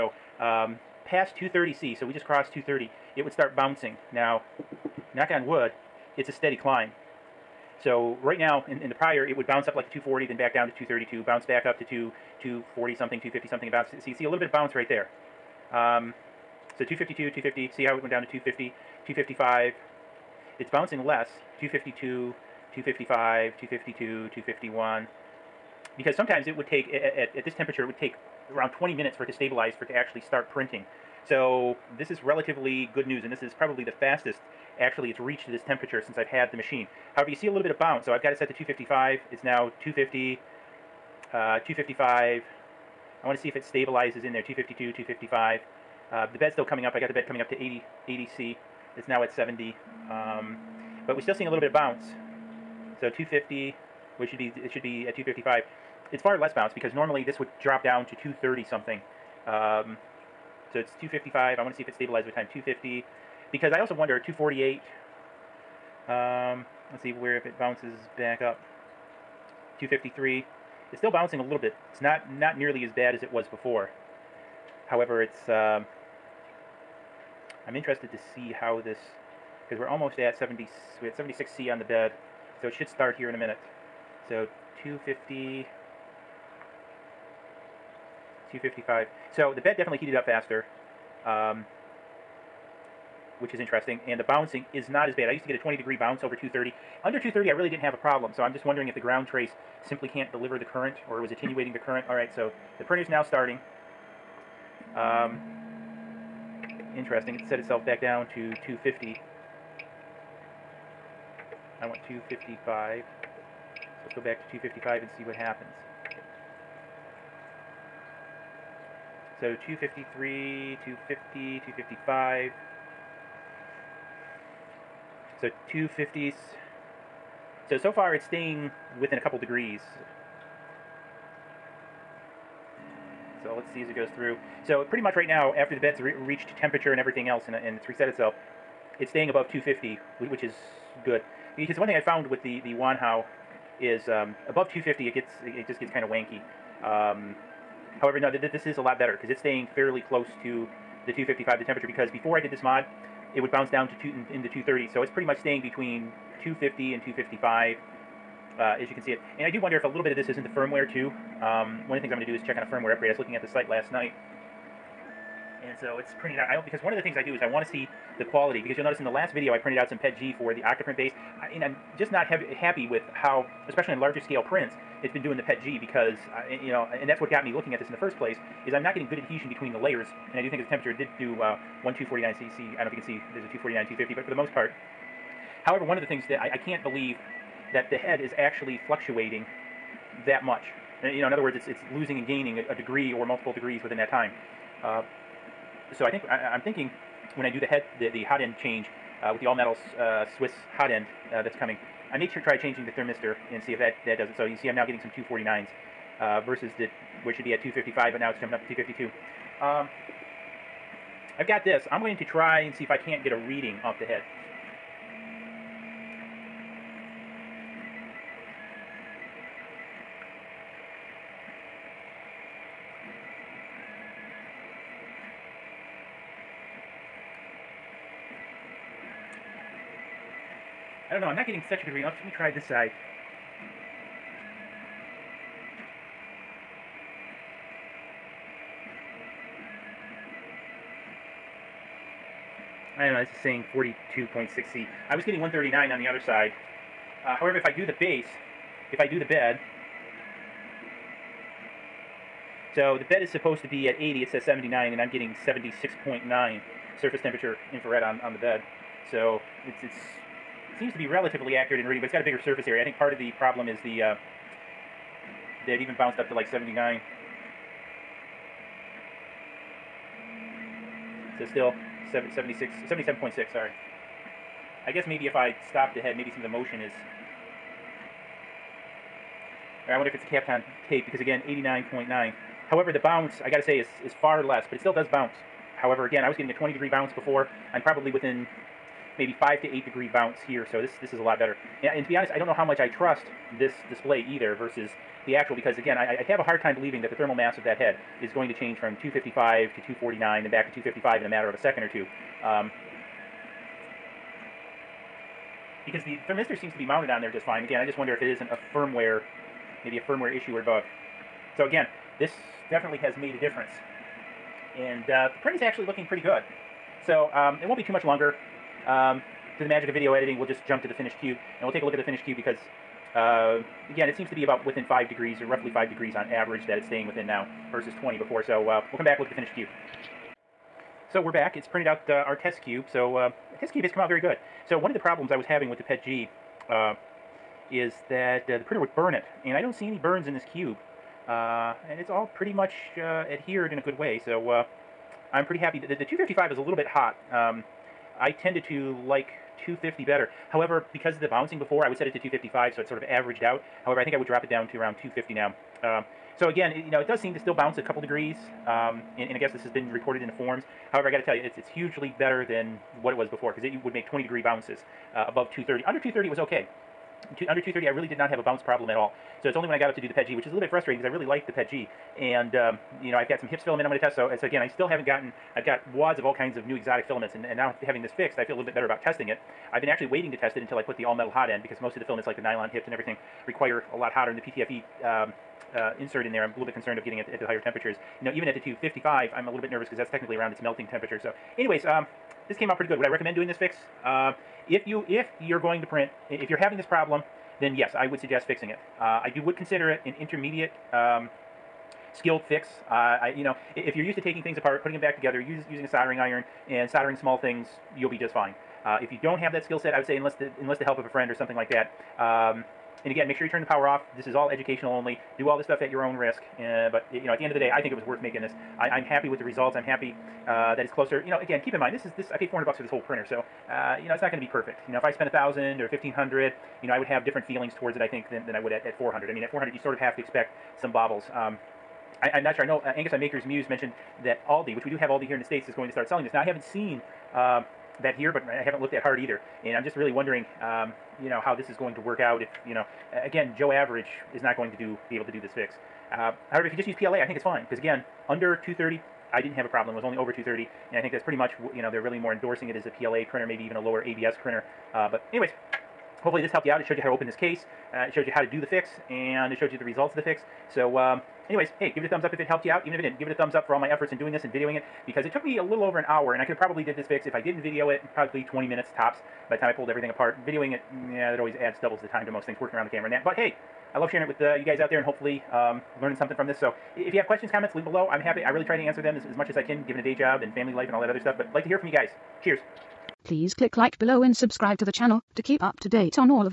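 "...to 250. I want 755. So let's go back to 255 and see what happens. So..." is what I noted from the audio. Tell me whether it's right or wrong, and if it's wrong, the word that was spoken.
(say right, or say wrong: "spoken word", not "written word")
wrong: "255", not "755".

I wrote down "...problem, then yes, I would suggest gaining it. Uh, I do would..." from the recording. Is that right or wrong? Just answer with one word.
wrong.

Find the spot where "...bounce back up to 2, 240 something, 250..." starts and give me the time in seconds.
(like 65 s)
11 s.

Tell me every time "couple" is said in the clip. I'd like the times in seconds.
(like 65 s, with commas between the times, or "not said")
129 s, 357 s.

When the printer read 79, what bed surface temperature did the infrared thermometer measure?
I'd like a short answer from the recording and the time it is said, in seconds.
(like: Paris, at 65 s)
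76.9C, at 255 s.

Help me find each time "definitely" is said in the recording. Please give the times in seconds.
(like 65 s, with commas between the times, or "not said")
89 s, 312 s.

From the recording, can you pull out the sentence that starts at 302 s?
Um, because the thermistor seems to be mounted on there just fine.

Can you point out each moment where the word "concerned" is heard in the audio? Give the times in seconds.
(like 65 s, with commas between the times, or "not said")
386 s.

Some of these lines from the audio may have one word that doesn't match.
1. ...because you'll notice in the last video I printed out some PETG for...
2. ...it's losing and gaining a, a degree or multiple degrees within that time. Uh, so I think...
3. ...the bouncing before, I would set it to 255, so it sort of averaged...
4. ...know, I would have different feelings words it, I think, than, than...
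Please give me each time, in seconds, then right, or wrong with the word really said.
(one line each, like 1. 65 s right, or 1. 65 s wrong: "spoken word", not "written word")
1. 168 s right
2. 191 s right
3. 351 s right
4. 426 s wrong: "towards", not "words".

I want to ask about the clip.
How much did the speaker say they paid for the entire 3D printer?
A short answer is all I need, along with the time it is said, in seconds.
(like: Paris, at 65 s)
$400, at 422 s.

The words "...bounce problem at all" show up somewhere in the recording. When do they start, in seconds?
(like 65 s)
368 s.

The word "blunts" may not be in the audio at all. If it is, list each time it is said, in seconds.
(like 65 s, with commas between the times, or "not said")
not said.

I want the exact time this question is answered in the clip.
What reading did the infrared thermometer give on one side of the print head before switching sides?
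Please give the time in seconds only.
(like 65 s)
245 s.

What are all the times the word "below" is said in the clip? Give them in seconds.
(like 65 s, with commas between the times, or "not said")
477 s, 483 s.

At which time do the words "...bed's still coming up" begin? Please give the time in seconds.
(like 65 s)
46 s.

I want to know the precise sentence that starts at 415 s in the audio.
Do all this stuff at your own risk.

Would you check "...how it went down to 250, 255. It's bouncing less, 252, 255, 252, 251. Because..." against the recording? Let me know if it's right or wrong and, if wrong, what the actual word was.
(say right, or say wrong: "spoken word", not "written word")
right.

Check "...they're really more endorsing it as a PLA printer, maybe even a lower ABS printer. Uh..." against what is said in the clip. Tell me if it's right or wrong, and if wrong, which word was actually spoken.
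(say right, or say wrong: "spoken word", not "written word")
right.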